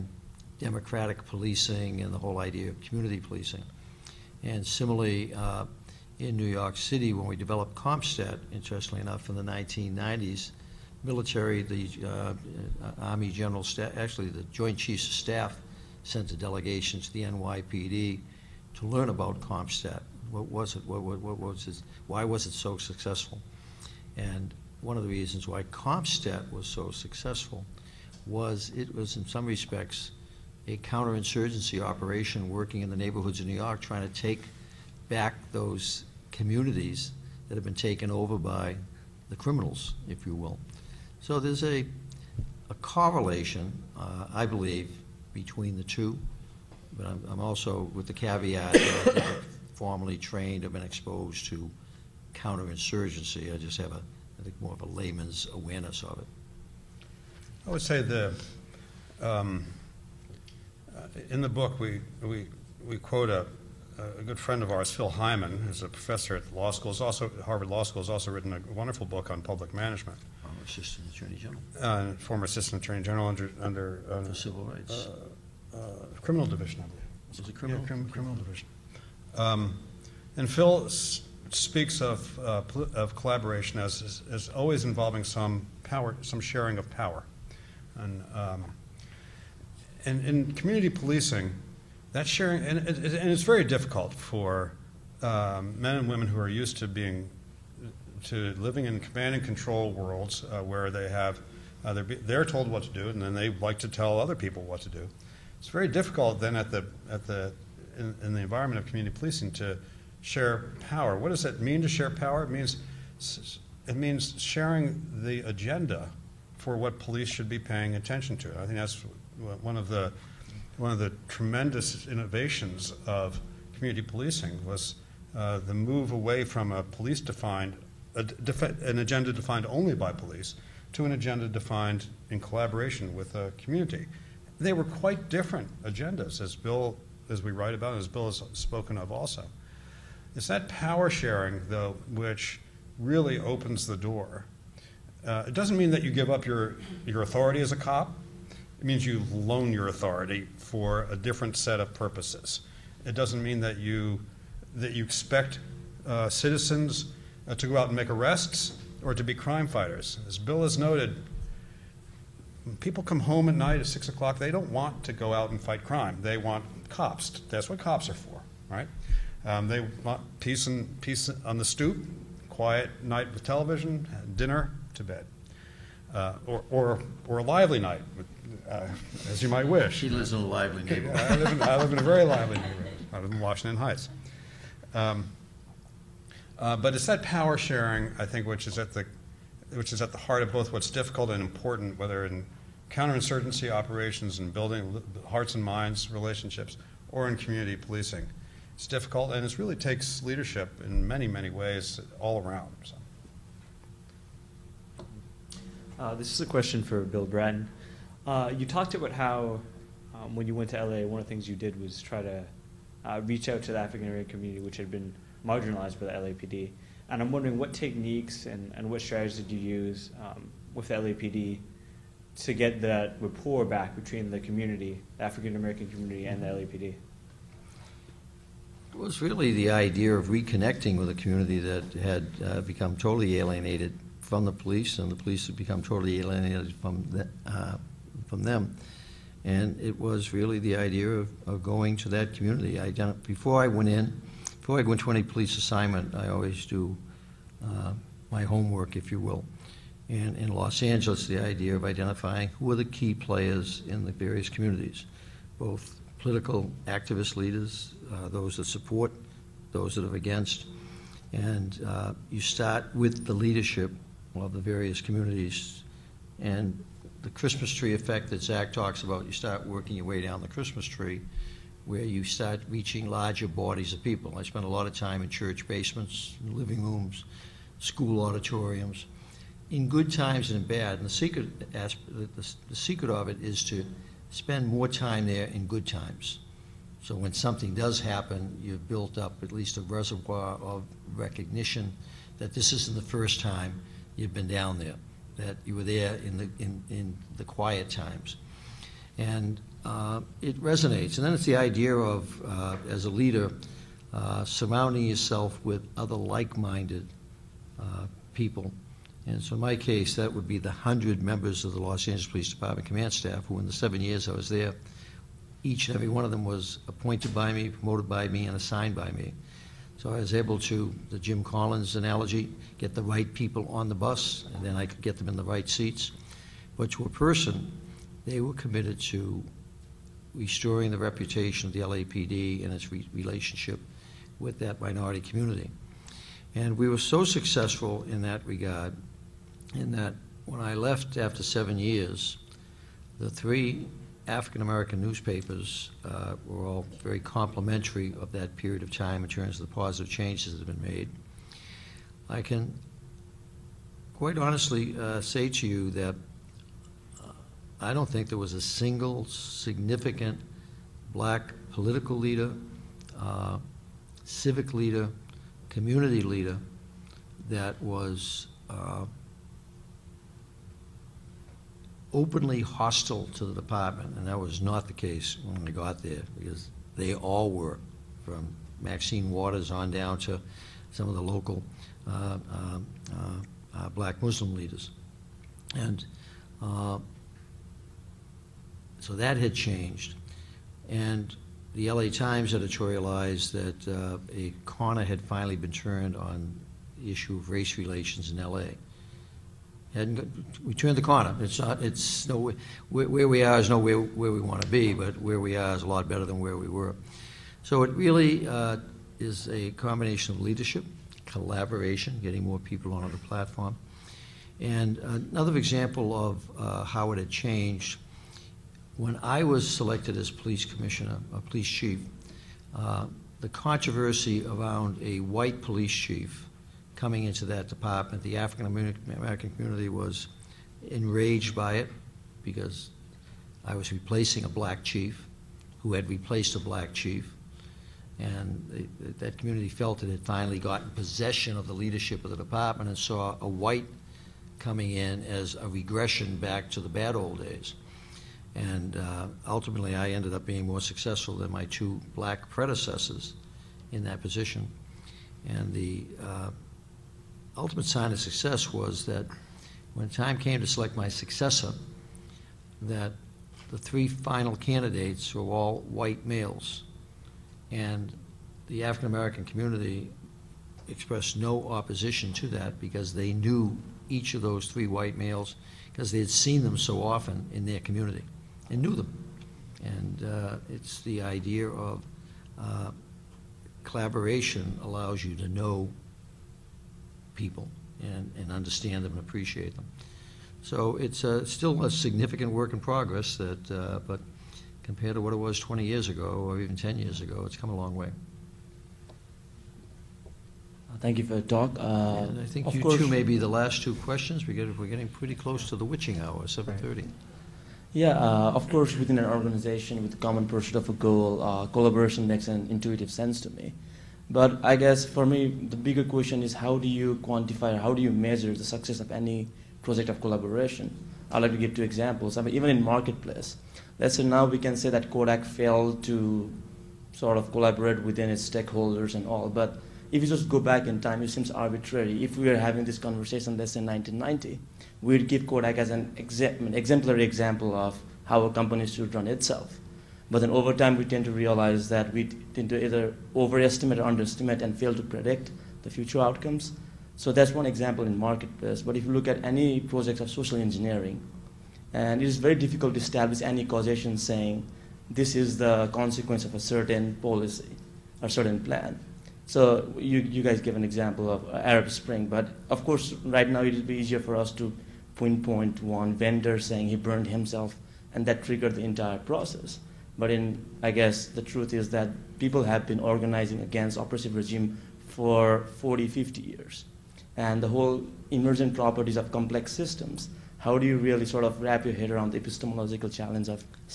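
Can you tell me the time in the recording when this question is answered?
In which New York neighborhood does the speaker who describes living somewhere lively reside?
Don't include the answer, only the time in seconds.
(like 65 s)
183 s.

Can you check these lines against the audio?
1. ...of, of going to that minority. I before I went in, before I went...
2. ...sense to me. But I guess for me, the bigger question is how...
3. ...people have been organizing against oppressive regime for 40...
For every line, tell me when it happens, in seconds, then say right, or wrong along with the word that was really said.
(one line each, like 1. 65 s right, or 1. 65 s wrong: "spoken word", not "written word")
1. 241 s wrong: "community", not "minority"
2. 513 s right
3. 572 s right.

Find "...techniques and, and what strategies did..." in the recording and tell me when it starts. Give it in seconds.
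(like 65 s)
217 s.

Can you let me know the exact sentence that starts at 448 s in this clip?
And uh, ultimately, I ended up being more successful than my two black predecessors in that position.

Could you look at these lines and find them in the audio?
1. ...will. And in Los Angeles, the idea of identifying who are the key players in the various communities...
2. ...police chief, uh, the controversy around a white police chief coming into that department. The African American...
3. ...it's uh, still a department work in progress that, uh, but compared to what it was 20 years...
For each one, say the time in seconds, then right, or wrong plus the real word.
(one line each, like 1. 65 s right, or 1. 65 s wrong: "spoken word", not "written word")
1. 249 s right
2. 421 s right
3. 490 s wrong: "significant", not "department".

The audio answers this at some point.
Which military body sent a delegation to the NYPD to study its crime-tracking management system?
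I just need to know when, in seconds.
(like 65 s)
14 s.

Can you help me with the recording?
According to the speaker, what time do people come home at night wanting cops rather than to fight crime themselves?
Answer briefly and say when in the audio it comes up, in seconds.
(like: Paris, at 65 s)
6 o'clock, at 163 s.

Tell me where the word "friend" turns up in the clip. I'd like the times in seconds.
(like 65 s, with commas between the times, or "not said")
64 s.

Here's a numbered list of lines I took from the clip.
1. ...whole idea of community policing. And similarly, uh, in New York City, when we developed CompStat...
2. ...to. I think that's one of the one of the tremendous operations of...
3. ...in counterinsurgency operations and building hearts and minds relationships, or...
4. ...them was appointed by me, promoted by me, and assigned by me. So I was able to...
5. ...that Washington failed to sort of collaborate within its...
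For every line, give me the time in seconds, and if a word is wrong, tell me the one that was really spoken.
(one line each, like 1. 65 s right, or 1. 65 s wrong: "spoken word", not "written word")
1. 2 s right
2. 118 s wrong: "innovations", not "operations"
3. 192 s right
4. 316 s right
5. 524 s wrong: "Kodak", not "Washington".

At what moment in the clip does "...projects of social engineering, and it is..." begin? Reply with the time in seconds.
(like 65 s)
549 s.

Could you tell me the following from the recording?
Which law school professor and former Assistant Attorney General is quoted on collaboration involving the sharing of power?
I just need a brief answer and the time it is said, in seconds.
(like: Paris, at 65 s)
Phil Heymann, at 64 s.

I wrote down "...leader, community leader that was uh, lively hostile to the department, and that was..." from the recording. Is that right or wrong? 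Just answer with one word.
wrong.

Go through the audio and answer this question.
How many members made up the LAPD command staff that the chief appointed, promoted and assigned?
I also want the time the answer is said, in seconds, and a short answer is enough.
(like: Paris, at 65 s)
100, at 310 s.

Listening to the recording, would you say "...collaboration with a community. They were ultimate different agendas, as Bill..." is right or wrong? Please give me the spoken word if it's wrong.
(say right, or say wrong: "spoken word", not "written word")
wrong: "quite", not "ultimate".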